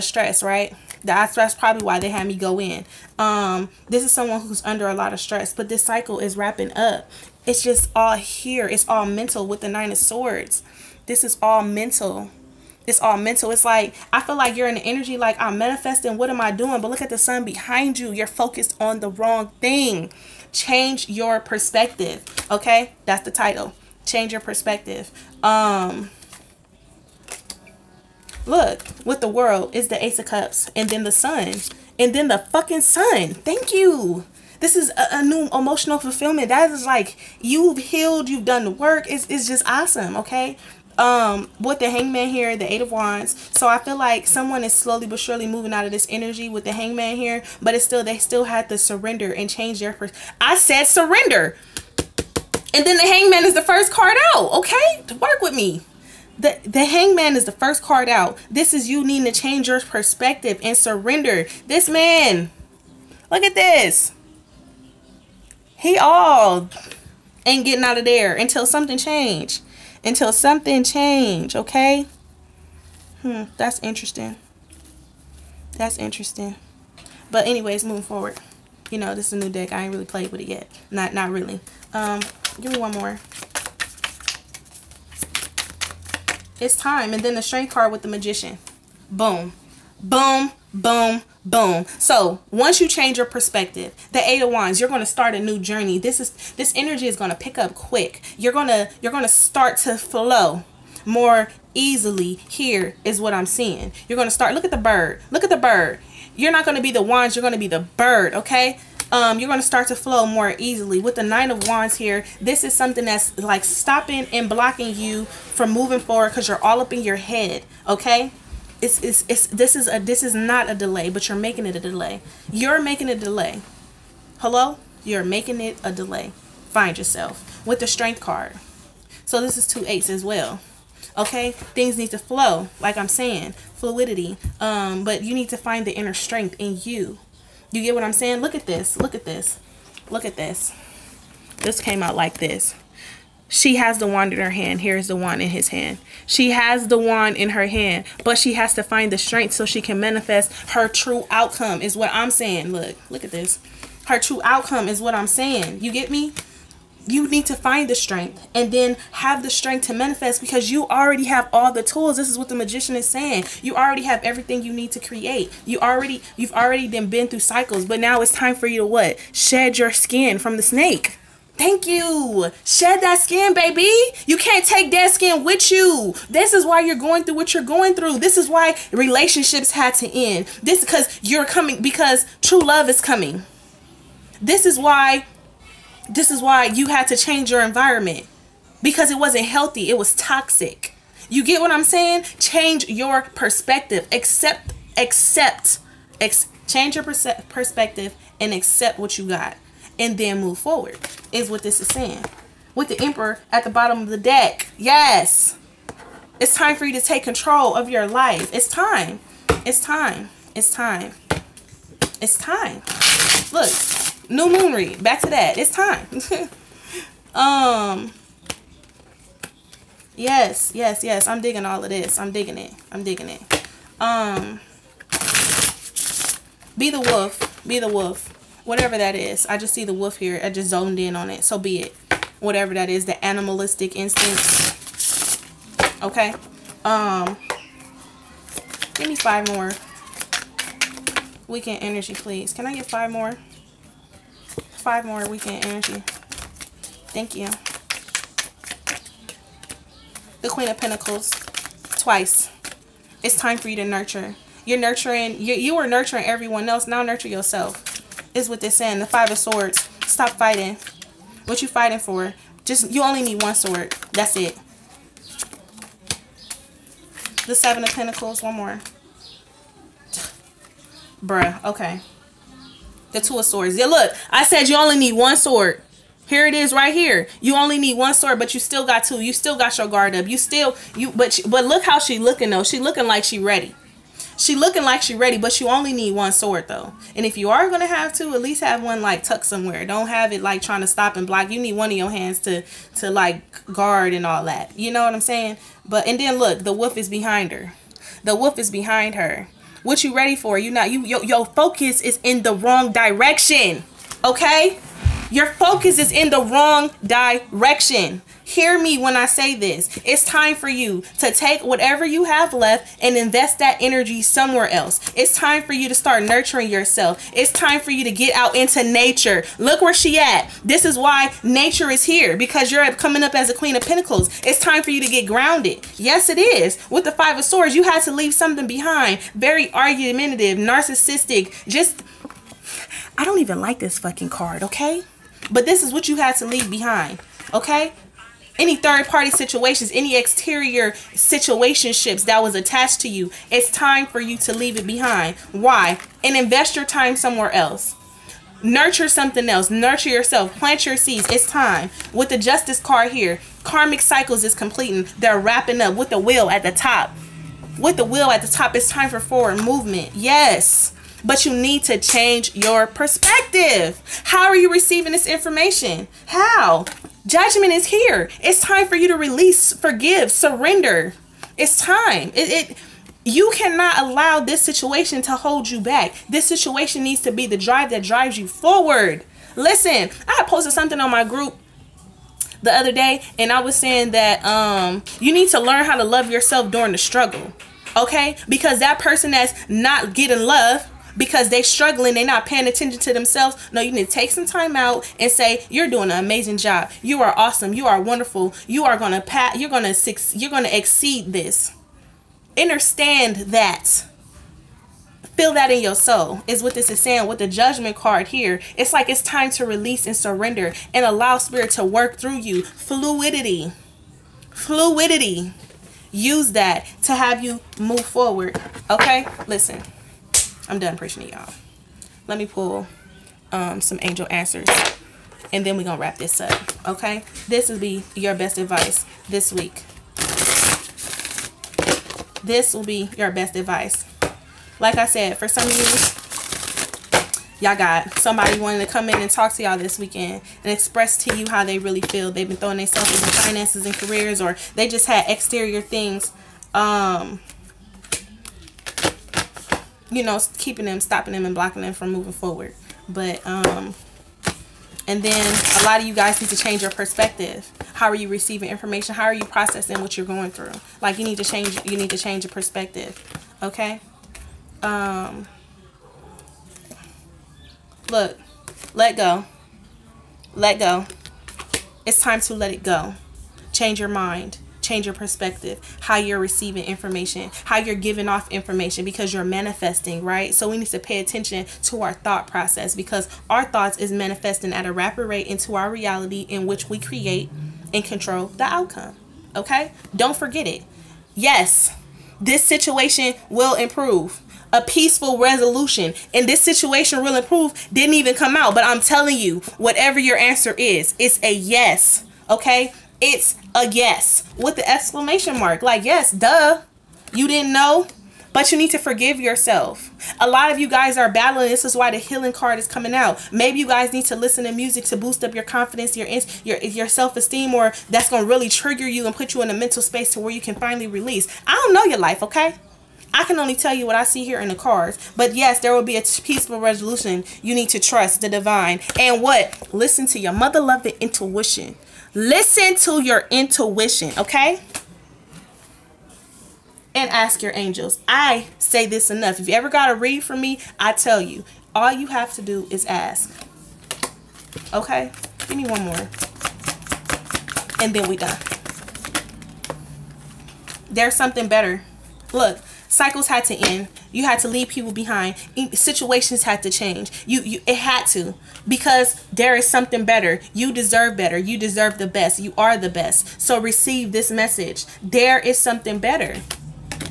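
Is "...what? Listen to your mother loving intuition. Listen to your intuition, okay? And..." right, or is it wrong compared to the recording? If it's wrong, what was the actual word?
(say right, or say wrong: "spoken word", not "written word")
right.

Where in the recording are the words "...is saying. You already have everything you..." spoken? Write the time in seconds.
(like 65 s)
162 s.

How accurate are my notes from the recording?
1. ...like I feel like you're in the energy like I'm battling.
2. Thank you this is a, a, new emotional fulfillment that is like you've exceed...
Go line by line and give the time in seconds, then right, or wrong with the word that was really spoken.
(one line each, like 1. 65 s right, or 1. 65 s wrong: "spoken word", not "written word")
1. 13 s wrong: "manifesting", not "battling"
2. 33 s wrong: "healed", not "exceed".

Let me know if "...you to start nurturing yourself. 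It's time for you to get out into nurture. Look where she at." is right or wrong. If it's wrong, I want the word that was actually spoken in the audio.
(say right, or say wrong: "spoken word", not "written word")
wrong: "nature", not "nurture".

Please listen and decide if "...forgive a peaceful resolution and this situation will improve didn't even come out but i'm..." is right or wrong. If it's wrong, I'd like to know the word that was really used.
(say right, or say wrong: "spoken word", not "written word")
wrong: "improve", not "forgive".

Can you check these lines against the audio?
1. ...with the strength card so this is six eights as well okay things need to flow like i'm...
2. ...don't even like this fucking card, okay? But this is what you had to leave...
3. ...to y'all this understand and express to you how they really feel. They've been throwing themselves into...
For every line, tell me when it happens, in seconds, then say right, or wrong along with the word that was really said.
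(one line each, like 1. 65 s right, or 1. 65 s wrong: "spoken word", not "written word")
1. 127 s wrong: "two", not "six"
2. 333 s right
3. 439 s wrong: "weekend", not "understand".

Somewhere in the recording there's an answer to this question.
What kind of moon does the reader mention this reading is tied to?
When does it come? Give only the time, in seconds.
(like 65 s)
214 s.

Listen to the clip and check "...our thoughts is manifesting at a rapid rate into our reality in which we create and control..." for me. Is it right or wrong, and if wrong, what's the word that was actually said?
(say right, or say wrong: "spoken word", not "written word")
right.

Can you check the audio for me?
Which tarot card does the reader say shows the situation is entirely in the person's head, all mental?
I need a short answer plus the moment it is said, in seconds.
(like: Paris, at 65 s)
Nine of Swords, at 9 s.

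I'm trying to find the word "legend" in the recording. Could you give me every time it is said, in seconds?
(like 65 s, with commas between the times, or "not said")
not said.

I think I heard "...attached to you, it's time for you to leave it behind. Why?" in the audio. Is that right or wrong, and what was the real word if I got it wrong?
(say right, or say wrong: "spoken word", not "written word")
right.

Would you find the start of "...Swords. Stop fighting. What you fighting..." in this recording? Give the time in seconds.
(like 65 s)
259 s.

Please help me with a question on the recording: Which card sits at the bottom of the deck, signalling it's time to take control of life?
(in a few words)
The Emperor.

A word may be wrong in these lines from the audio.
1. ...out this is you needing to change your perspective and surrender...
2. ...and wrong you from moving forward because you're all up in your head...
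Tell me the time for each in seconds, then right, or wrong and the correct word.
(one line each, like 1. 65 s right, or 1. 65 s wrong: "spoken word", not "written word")
1. 58 s right
2. 114 s wrong: "blocking", not "wrong".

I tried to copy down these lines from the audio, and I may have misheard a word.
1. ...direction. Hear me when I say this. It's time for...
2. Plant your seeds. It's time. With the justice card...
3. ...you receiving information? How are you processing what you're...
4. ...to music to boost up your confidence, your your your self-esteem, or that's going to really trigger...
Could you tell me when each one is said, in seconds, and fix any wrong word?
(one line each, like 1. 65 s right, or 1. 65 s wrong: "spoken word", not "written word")
1. 307 s right
2. 350 s right
3. 458 s right
4. 514 s right.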